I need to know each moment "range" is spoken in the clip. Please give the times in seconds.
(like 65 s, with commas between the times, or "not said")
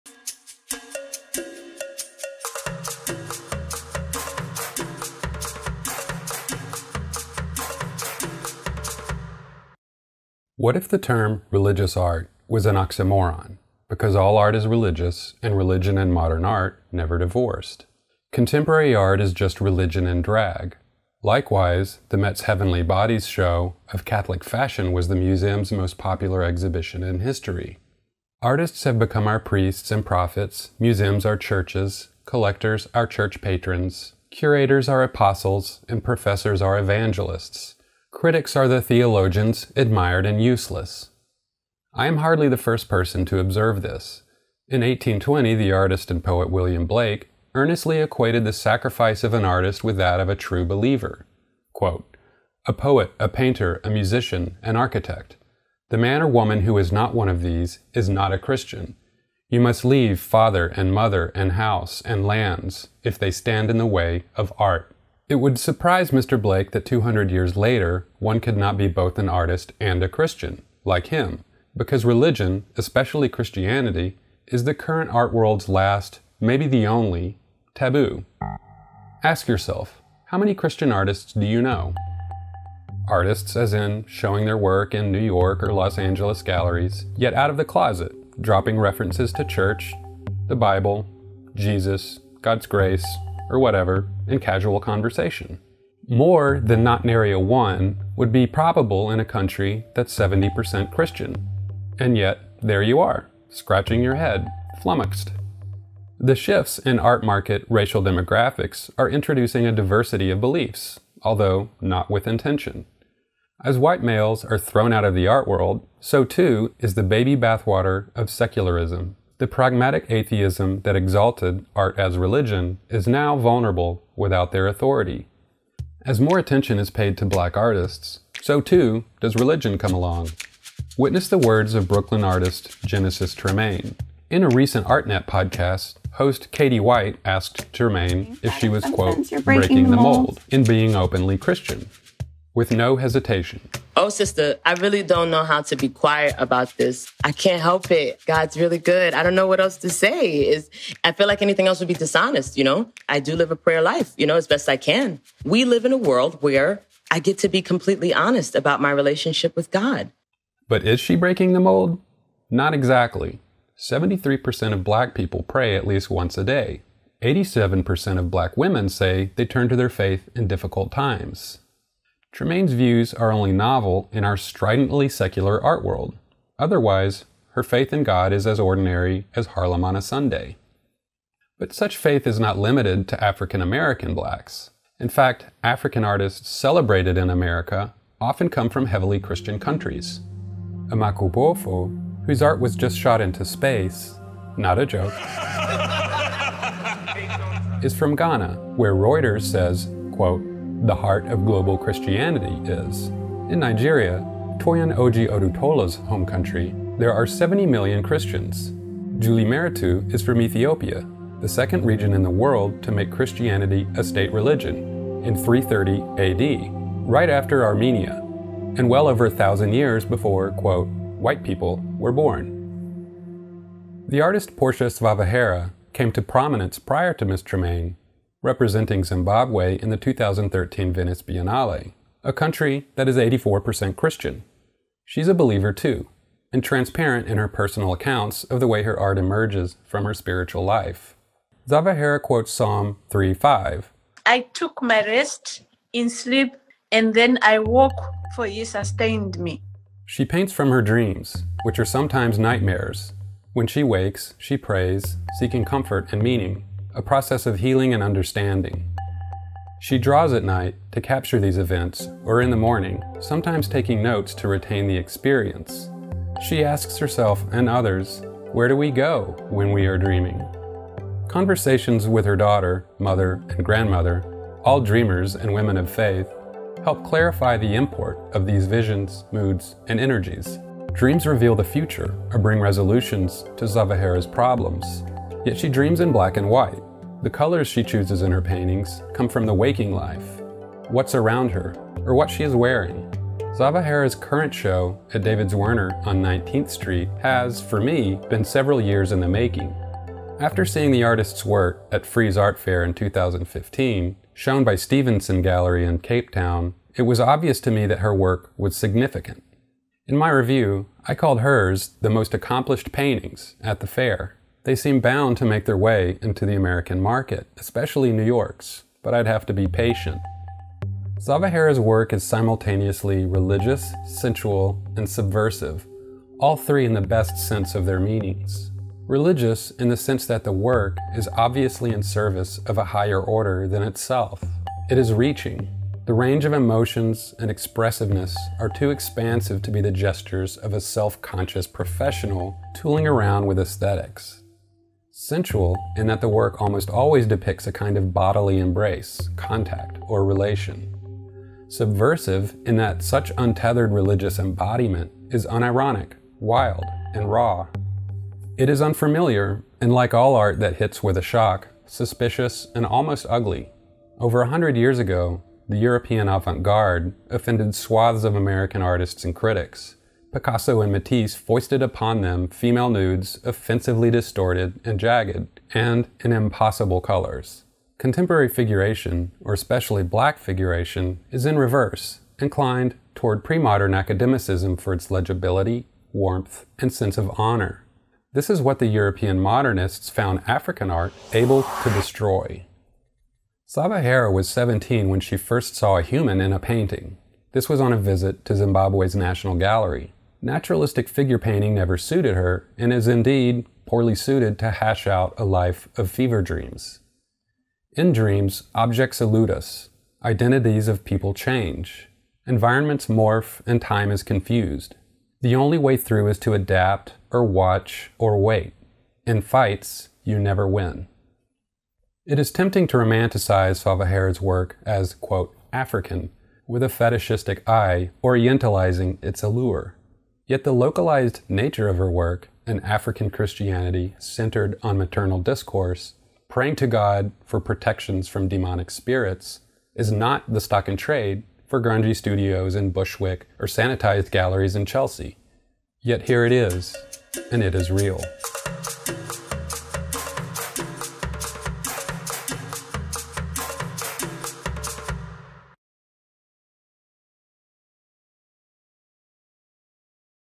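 336 s.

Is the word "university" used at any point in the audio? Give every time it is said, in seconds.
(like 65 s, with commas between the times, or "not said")
not said.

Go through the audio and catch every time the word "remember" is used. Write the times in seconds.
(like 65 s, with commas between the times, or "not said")
not said.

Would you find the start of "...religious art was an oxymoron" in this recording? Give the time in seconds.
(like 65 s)
11 s.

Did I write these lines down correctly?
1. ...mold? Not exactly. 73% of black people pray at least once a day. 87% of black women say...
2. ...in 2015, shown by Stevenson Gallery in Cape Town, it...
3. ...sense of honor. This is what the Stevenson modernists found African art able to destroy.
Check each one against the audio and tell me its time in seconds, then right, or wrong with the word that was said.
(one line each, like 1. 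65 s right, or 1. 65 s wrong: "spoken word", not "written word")
1. 161 s right
2. 302 s right
3. 386 s wrong: "European", not "Stevenson".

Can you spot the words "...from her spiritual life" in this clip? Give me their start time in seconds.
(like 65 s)
239 s.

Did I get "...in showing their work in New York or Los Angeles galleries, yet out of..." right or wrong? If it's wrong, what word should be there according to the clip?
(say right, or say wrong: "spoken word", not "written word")
right.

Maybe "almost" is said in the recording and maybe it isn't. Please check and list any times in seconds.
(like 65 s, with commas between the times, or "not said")
346 s, 362 s.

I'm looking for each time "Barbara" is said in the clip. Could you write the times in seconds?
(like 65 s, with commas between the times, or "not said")
not said.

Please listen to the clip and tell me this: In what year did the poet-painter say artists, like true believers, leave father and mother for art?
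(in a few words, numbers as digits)
1820.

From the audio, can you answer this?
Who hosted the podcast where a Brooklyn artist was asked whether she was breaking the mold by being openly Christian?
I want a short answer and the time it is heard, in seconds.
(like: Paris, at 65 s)
Katie White, at 136 s.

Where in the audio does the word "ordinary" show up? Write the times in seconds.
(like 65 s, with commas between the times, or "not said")
178 s.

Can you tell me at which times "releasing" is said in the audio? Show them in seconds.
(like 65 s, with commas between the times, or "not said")
not said.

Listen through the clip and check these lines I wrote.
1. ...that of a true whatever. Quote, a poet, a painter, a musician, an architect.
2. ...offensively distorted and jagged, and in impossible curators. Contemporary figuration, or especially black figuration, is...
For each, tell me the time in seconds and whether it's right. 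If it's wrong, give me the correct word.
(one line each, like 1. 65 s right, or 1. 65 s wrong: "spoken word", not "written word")
1. 49 s wrong: "believer", not "whatever"
2. 373 s wrong: "colors", not "curators".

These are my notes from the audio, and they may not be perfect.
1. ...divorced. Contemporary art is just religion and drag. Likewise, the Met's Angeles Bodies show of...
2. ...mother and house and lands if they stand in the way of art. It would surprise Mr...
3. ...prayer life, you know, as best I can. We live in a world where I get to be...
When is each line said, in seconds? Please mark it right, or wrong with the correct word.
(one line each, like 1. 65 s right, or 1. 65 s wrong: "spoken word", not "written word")
1. 17 s wrong: "Heavenly", not "Angeles"
2. 60 s right
3. 153 s right.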